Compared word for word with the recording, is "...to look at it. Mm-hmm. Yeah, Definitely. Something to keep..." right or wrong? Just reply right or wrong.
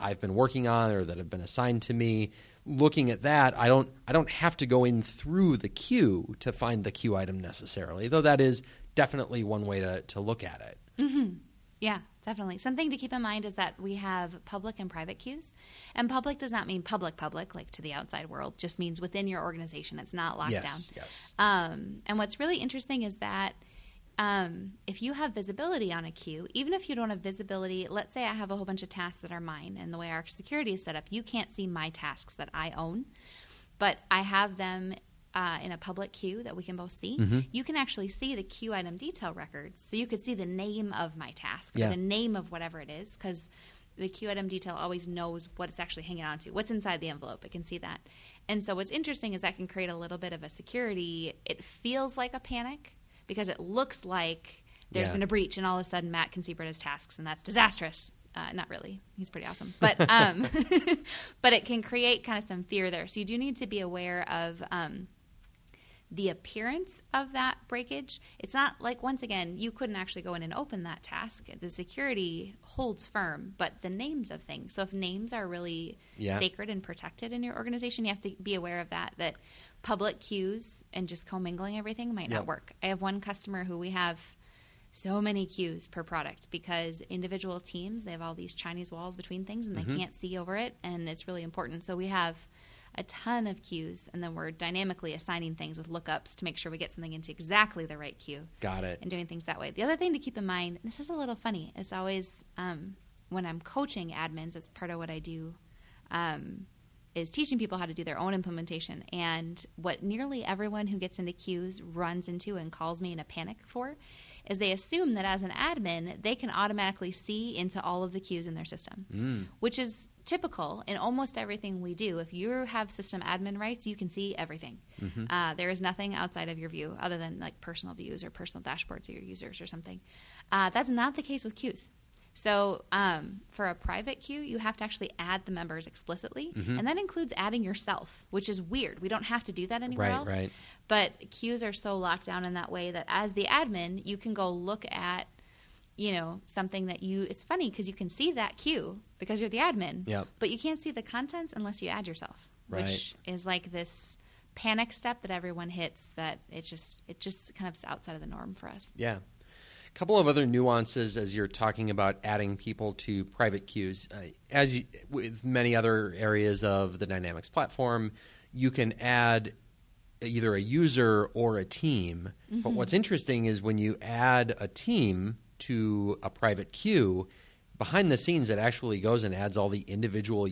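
right.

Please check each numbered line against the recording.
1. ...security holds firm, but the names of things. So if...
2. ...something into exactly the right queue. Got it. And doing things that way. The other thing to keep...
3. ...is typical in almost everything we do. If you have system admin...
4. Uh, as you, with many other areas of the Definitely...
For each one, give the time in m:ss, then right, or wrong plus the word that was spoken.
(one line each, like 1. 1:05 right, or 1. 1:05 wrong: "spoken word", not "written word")
1. 1:11 right
2. 1:36 right
3. 1:59 right
4. 2:44 wrong: "Dynamics", not "Definitely".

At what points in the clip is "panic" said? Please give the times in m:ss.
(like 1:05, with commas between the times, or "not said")
0:52, 1:53, 2:34.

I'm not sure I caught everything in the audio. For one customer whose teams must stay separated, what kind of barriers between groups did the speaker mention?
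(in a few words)
chinese walls.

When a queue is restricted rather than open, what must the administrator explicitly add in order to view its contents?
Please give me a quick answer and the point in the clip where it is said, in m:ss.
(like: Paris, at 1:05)
members, at 2:15.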